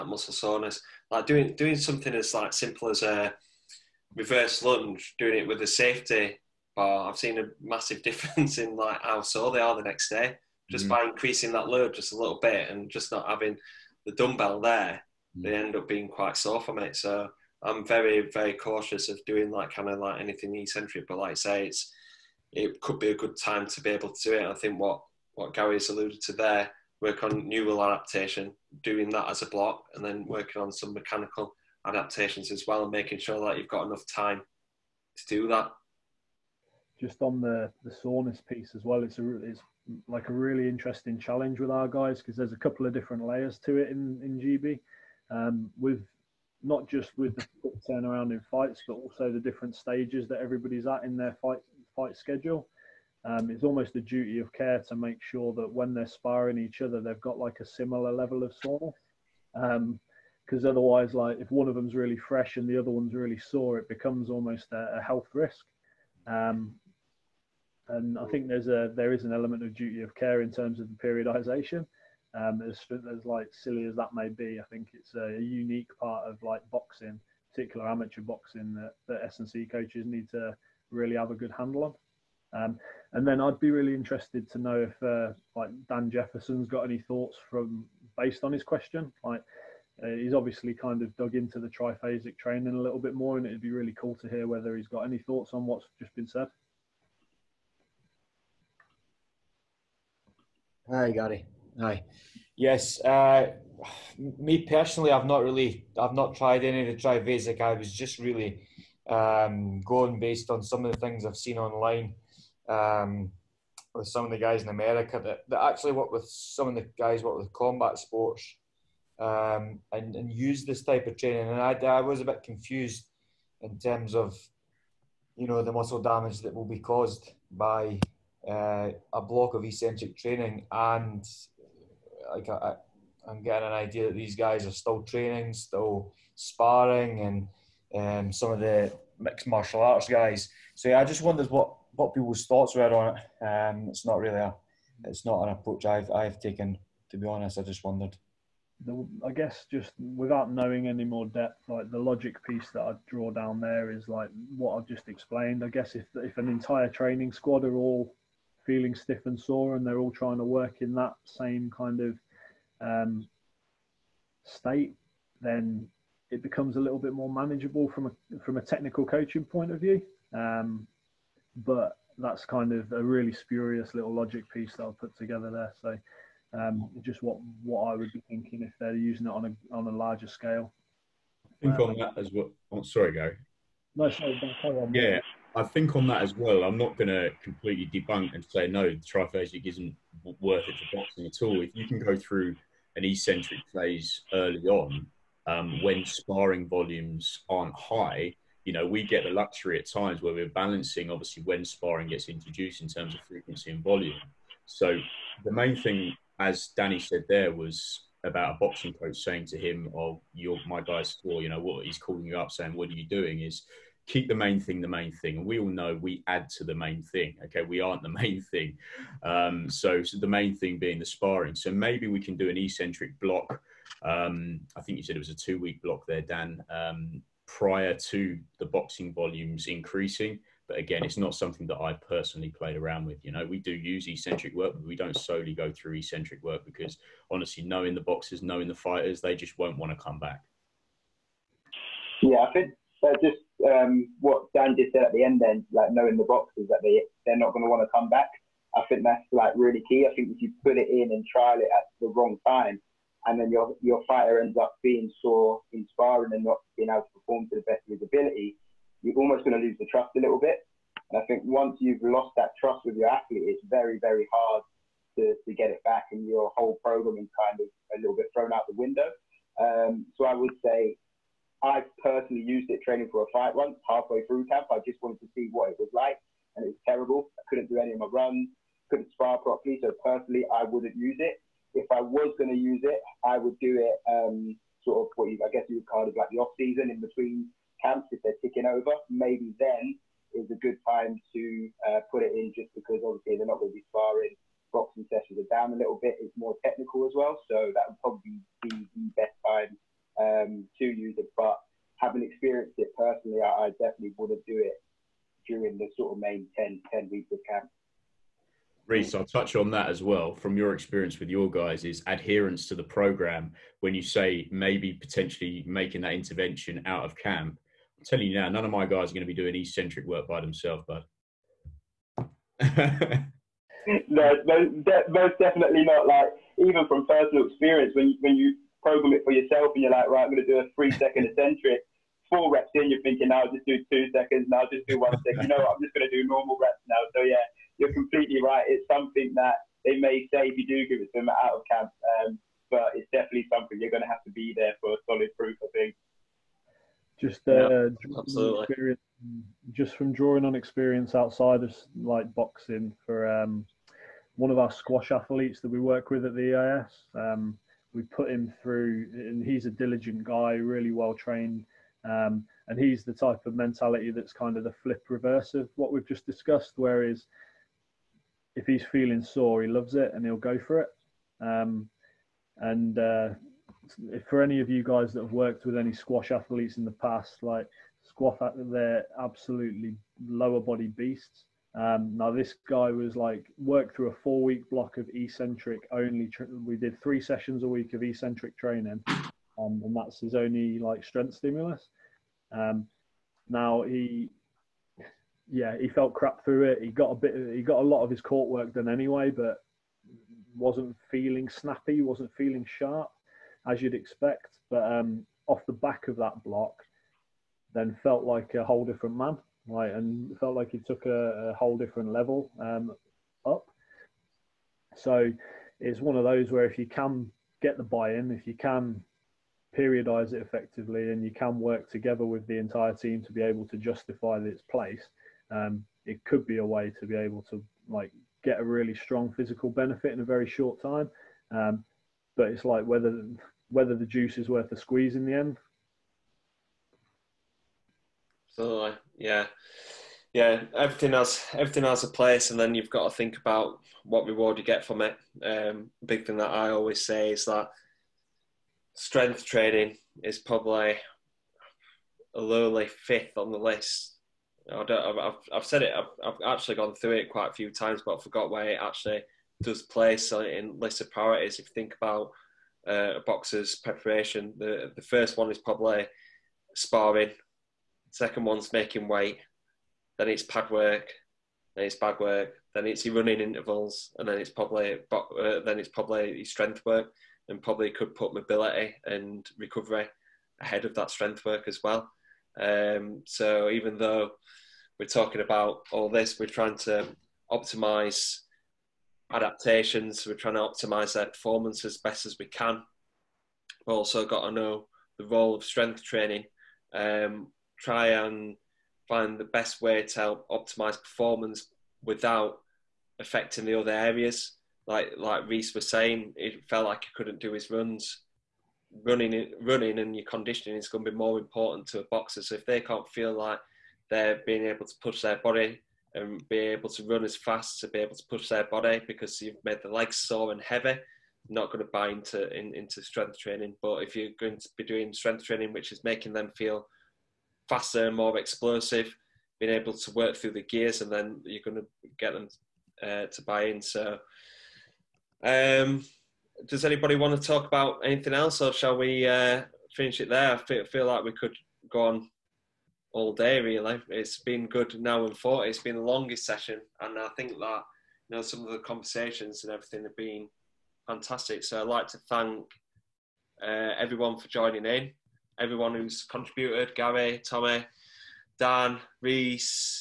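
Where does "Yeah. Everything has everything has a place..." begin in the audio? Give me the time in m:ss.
7:20.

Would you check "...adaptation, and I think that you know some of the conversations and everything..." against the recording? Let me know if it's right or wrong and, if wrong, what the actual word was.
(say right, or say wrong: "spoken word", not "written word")
wrong: "session", not "adaptation".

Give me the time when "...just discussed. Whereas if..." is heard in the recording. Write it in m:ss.
6:06.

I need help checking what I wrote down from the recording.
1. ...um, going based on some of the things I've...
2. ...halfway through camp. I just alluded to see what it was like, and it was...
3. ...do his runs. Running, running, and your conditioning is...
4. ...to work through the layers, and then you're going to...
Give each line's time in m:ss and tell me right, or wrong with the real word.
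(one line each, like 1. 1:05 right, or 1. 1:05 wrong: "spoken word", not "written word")
1. 1:49 right
2. 4:33 wrong: "wanted", not "alluded"
3. 8:27 right
4. 8:49 wrong: "gears", not "layers".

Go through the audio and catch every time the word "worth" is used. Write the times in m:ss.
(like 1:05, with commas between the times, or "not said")
3:10, 7:14.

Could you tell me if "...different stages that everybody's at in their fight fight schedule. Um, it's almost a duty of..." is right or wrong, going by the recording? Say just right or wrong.
right.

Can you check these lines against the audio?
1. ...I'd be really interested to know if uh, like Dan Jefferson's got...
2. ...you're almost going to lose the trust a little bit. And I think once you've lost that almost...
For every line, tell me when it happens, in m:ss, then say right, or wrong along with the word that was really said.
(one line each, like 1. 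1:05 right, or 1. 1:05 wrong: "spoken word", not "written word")
1. 1:23 right
2. 4:19 wrong: "trust", not "almost".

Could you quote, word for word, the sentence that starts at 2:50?
Um, but that's kind of a really spurious little logic piece that I'll put together there.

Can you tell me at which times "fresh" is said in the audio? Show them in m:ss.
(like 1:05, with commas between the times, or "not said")
1:02.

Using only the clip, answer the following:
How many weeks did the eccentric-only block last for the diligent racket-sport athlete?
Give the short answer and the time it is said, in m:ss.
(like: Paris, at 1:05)
4, at 6:24.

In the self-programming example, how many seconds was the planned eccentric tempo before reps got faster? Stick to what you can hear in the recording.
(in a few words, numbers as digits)
3.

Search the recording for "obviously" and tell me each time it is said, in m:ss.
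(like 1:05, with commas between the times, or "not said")
1:30, 3:21, 4:53.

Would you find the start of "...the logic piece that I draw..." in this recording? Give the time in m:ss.
2:31.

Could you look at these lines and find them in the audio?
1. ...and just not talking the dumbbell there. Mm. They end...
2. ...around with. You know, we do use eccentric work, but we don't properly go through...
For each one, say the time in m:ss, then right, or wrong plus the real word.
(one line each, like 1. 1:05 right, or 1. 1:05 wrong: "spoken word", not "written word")
1. 0:12 wrong: "having", not "talking"
2. 3:52 wrong: "solely", not "properly".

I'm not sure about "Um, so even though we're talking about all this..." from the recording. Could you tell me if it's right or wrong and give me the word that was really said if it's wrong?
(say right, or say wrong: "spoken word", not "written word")
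right.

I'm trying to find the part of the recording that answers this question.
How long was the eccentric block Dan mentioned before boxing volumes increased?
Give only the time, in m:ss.
3:45.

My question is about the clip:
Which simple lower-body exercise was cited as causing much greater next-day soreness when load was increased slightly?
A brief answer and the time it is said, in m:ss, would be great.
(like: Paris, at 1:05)
Reverse lunge, at 0:04.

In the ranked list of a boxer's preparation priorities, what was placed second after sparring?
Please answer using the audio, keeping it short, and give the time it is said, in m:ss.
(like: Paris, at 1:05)
Making weight, at 7:48.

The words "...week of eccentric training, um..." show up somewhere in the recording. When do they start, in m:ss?
6:27.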